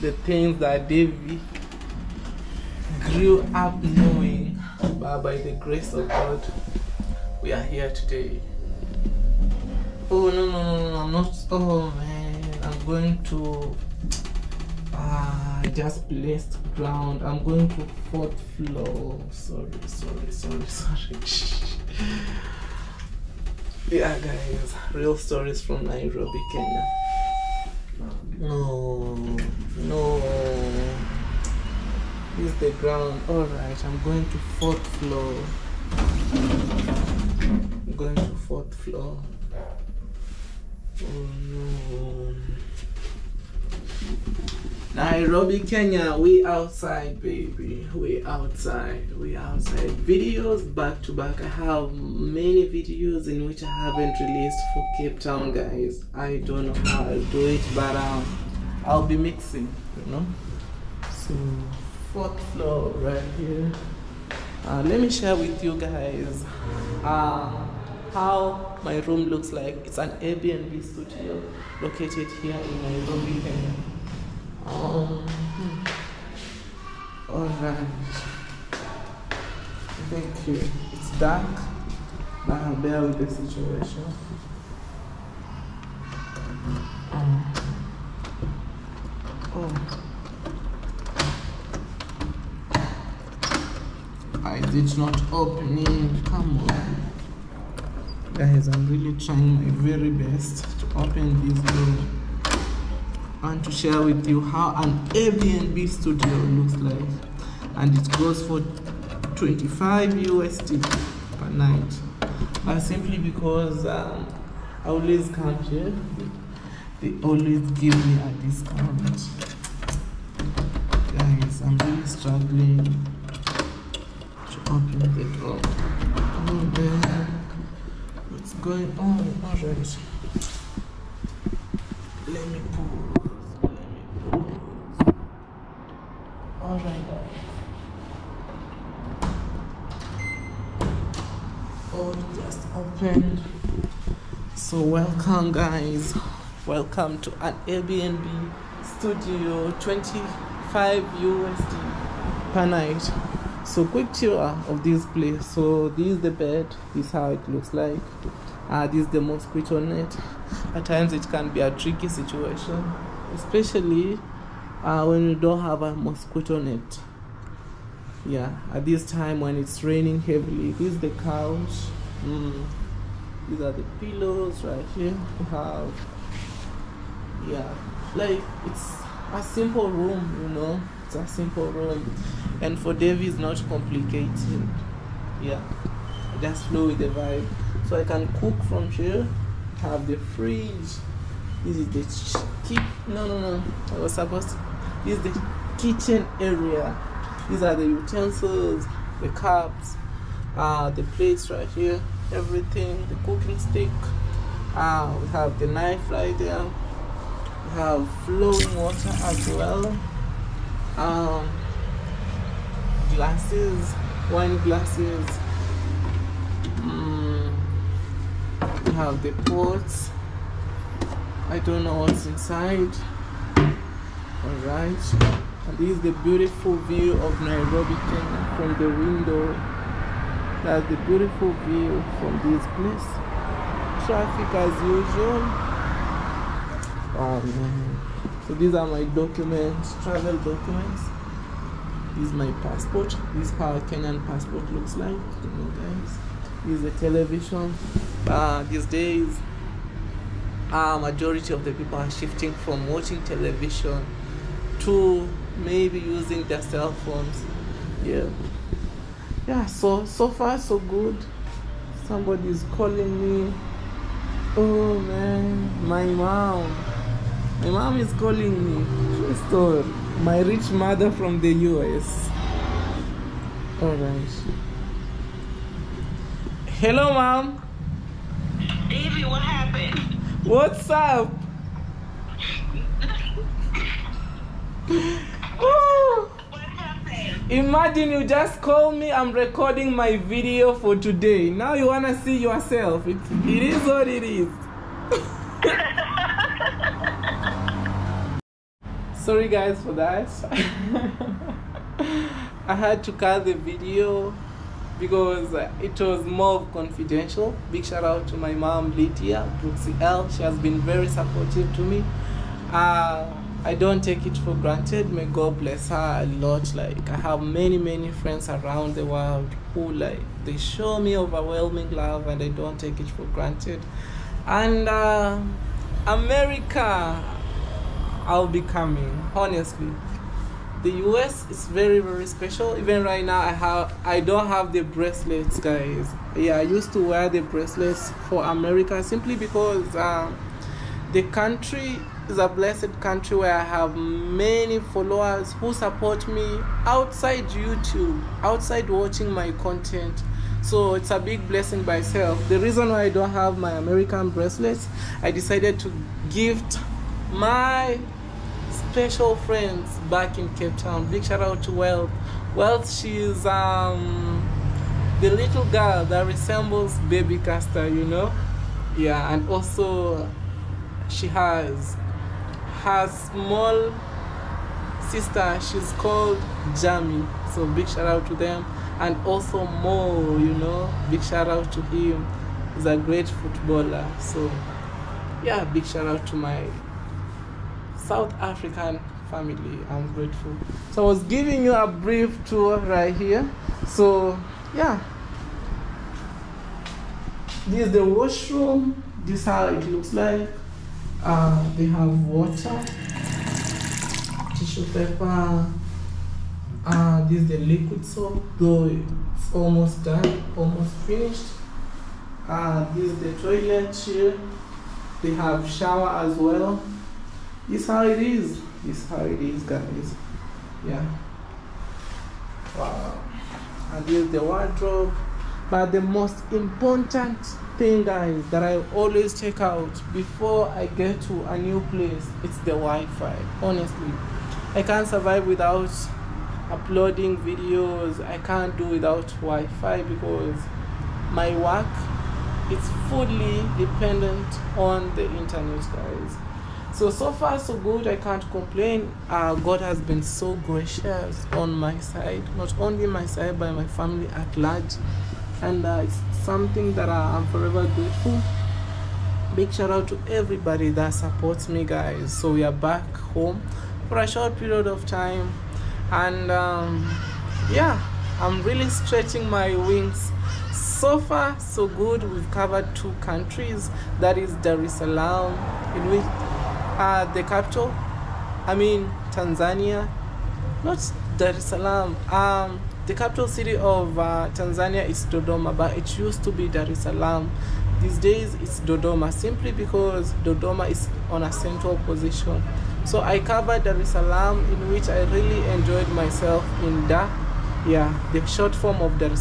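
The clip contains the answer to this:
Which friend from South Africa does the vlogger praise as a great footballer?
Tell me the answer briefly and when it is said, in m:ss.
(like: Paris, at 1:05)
Mo, at 6:19.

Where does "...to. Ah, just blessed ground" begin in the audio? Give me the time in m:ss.
0:13.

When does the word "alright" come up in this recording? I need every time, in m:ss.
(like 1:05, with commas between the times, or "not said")
0:33, 2:09, 3:44.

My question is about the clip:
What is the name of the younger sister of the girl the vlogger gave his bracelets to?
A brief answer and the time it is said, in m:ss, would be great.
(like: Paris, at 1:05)
Jamie, at 6:16.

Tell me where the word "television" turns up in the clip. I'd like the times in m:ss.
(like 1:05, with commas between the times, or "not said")
4:07, 4:13.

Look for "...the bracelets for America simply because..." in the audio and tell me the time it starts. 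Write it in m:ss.
5:37.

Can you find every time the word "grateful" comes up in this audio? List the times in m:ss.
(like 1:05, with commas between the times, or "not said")
6:30, 7:37.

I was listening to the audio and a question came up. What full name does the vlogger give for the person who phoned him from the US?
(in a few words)
Lydia Brooksy L.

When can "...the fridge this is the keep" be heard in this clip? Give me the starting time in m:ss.
3:10.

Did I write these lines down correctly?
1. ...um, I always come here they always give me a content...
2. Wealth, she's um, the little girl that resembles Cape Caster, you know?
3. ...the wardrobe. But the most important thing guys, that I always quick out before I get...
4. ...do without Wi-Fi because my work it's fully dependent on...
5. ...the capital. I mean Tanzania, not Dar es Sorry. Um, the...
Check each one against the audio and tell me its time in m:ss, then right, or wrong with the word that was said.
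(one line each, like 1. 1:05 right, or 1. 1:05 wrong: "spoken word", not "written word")
1. 1:53 wrong: "discount", not "content"
2. 6:02 wrong: "Baby", not "Cape"
3. 7:04 wrong: "check", not "quick"
4. 7:18 right
5. 7:57 wrong: "Salaam", not "Sorry".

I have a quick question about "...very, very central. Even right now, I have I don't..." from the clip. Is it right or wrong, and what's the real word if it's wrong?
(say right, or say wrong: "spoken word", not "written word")
wrong: "special", not "central".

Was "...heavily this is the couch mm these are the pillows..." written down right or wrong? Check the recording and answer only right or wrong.
right.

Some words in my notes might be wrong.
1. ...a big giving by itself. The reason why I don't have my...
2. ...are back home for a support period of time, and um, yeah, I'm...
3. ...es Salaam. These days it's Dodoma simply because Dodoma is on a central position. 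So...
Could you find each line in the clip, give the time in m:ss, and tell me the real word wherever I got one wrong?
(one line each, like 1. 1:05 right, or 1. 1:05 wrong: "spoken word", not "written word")
1. 5:51 wrong: "blessing", not "giving"
2. 7:42 wrong: "short", not "support"
3. 8:06 right.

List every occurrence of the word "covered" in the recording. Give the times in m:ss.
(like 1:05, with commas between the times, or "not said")
7:52, 8:13.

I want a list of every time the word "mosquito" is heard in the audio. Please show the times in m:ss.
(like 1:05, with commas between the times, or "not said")
2:39, 2:45.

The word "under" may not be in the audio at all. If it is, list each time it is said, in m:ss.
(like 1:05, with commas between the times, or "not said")
not said.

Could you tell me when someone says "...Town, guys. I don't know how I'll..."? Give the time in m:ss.
0:55.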